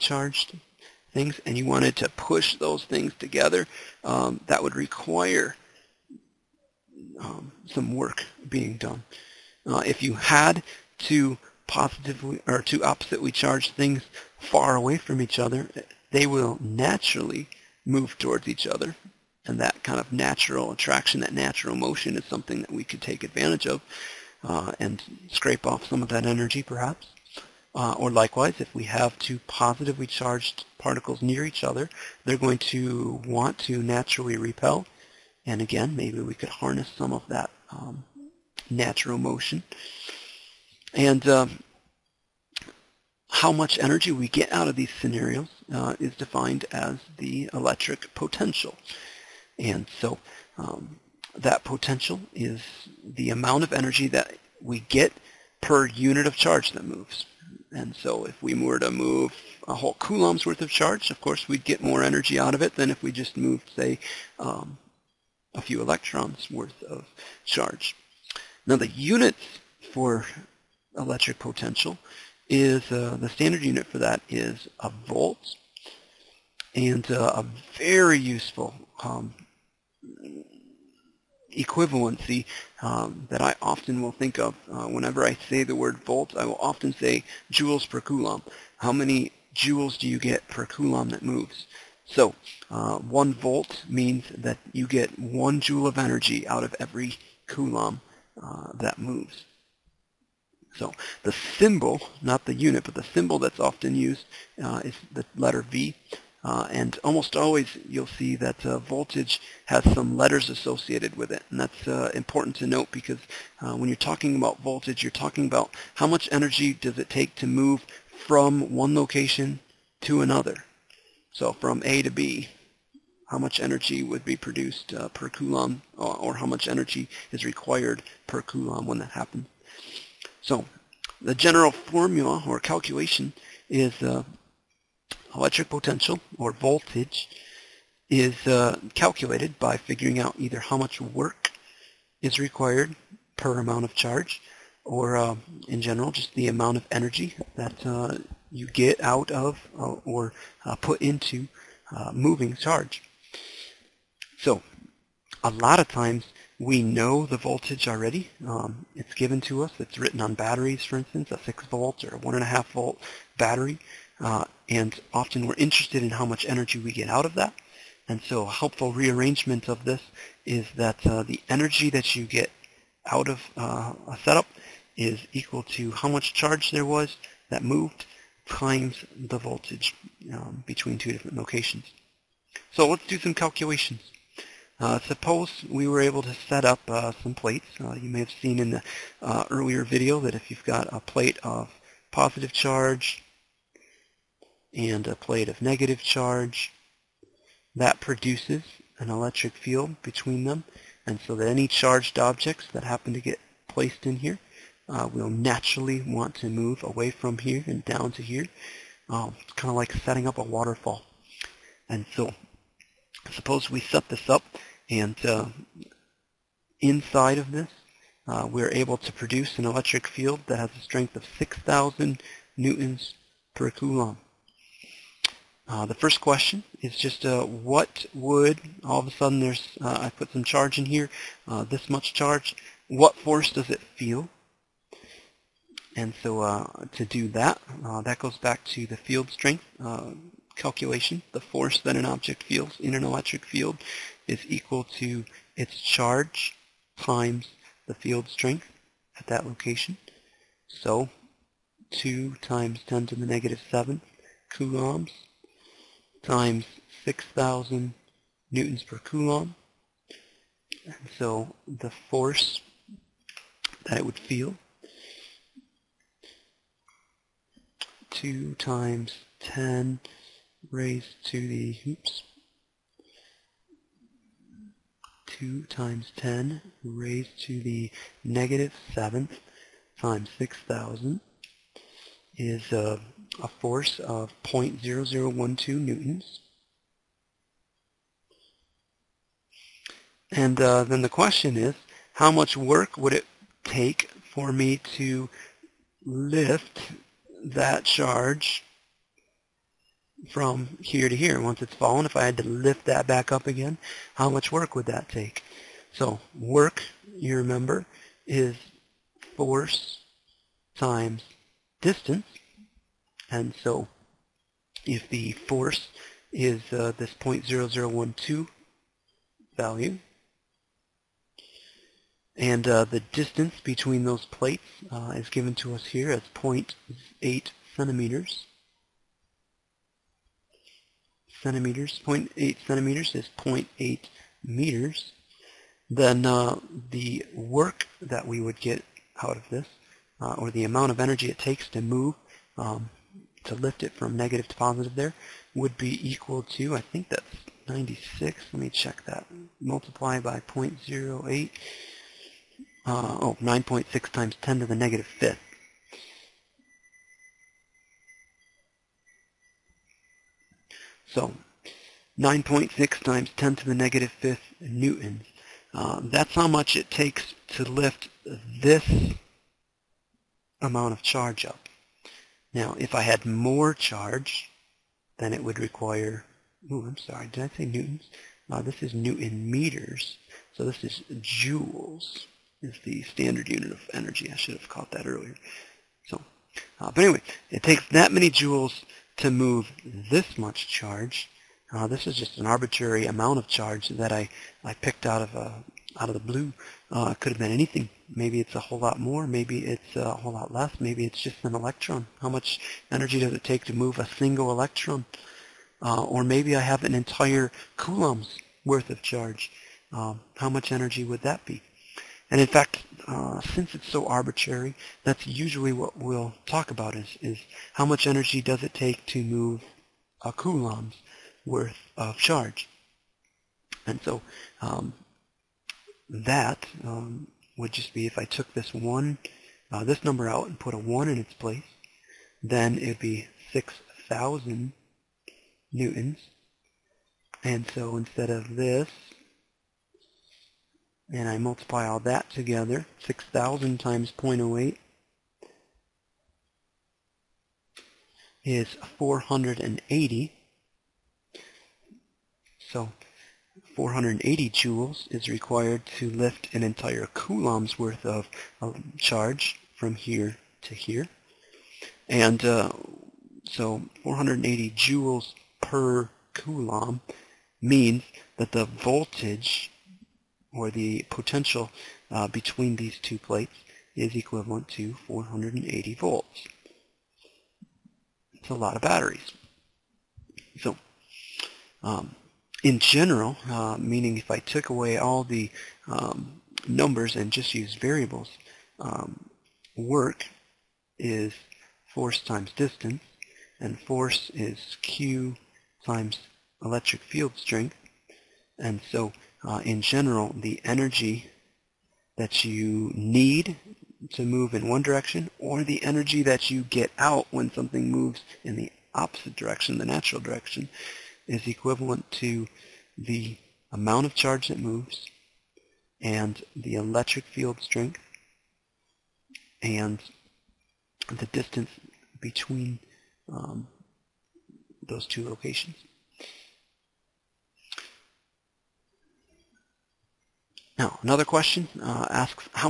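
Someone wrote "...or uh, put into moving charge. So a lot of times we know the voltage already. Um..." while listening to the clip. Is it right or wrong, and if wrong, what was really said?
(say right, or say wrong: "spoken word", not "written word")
right.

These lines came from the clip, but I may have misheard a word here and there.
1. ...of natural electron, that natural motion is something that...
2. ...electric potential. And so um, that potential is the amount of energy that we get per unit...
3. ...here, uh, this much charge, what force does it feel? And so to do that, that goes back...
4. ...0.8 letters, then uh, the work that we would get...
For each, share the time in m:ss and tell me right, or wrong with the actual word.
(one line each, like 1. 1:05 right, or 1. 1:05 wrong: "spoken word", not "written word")
1. 0:19 wrong: "attraction", not "electron"
2. 0:47 right
3. 3:50 right
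4. 5:33 wrong: "meters", not "letters".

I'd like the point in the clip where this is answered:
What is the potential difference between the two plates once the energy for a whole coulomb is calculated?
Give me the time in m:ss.
7:55.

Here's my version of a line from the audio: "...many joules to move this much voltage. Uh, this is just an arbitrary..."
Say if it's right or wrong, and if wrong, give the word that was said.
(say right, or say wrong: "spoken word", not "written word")
wrong: "charge", not "voltage".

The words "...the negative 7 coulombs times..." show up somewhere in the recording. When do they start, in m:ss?
4:13.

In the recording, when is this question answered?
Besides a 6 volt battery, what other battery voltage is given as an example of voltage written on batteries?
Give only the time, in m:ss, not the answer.
2:42.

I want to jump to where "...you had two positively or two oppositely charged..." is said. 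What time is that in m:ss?
0:10.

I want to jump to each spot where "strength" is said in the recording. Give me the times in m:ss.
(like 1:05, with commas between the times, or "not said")
3:40, 3:59, 4:08, 8:17, 8:37.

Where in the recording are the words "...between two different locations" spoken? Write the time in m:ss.
3:00.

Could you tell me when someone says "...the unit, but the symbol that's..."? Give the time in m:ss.
1:42.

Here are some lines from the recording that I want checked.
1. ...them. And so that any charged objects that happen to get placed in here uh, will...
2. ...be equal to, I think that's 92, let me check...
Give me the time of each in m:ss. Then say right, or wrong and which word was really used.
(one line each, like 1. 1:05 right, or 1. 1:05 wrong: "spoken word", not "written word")
1. 3:20 right
2. 5:45 wrong: "96", not "92".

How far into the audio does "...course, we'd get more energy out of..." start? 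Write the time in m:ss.
1:01.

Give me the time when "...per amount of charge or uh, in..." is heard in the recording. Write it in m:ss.
2:23.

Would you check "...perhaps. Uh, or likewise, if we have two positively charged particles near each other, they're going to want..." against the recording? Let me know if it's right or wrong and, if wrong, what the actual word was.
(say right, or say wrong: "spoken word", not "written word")
right.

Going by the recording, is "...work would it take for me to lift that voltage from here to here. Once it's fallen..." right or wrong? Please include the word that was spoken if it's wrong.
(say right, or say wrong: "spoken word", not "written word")
wrong: "charge", not "voltage".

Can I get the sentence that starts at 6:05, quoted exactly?
Uh, that's how much it takes to lift this amount of charge up.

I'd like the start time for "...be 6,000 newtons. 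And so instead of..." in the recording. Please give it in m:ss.
7:12.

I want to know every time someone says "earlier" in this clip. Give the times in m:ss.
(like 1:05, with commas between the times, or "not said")
3:09, 6:25.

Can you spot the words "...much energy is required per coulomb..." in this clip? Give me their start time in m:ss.
2:06.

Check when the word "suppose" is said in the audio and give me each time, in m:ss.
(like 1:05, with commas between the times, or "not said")
3:04, 3:33.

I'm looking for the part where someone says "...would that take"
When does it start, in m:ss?
5:04.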